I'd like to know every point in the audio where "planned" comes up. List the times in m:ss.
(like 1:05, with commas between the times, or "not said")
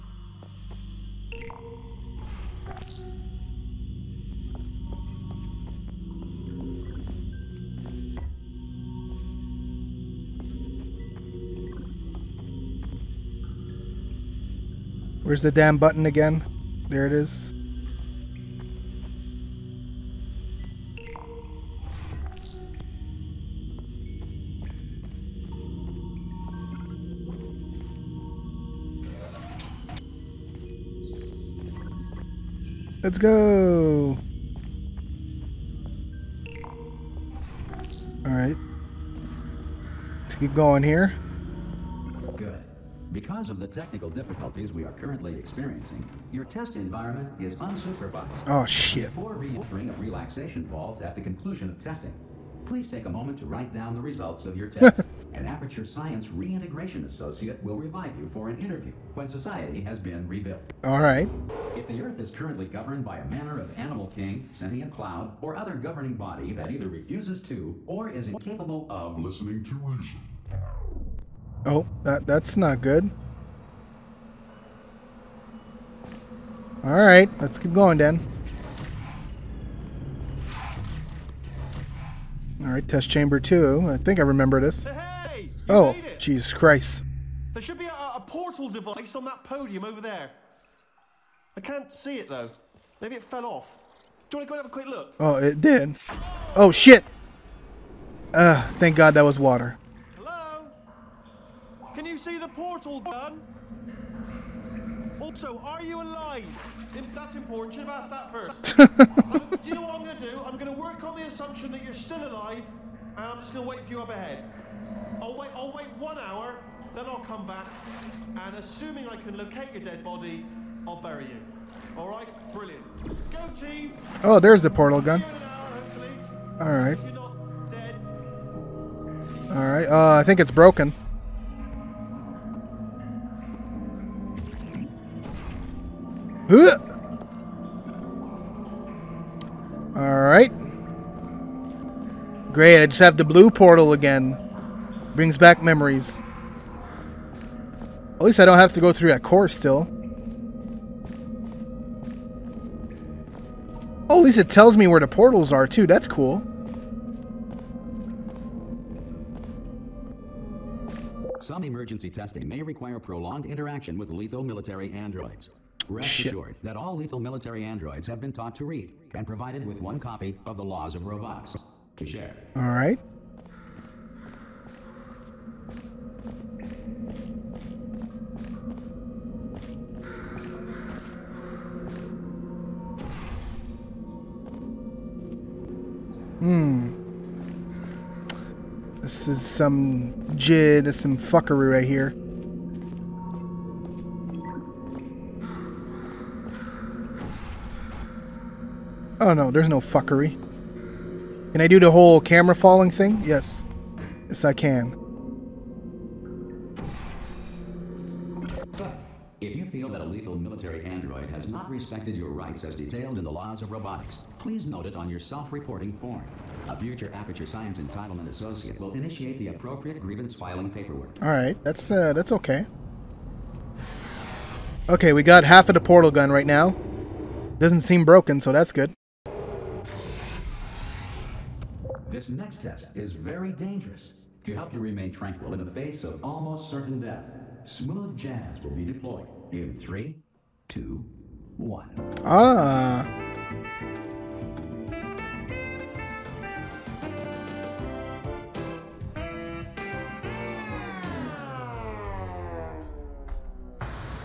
not said.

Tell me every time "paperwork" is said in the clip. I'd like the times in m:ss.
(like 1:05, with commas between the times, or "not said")
3:40.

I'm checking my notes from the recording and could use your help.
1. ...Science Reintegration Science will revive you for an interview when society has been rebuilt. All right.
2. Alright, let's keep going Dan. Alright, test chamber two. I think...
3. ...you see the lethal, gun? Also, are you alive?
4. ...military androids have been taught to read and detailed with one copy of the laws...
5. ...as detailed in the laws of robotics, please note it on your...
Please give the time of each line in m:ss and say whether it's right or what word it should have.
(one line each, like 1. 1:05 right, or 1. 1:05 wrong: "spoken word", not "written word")
1. 0:55 wrong: "Associate", not "Science"
2. 1:16 right
3. 1:42 wrong: "portal", not "lethal"
4. 2:47 wrong: "provided", not "detailed"
5. 3:32 right.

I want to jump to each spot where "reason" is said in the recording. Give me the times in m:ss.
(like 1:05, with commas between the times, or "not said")
1:09.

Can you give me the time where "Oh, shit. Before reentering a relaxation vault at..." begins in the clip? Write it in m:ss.
0:48.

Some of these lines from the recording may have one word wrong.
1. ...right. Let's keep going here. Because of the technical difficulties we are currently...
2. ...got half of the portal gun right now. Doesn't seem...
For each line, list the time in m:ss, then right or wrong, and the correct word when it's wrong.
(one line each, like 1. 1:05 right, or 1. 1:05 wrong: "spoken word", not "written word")
1. 0:38 right
2. 3:45 right.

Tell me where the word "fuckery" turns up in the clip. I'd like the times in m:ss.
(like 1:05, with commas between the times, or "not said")
3:11, 3:19.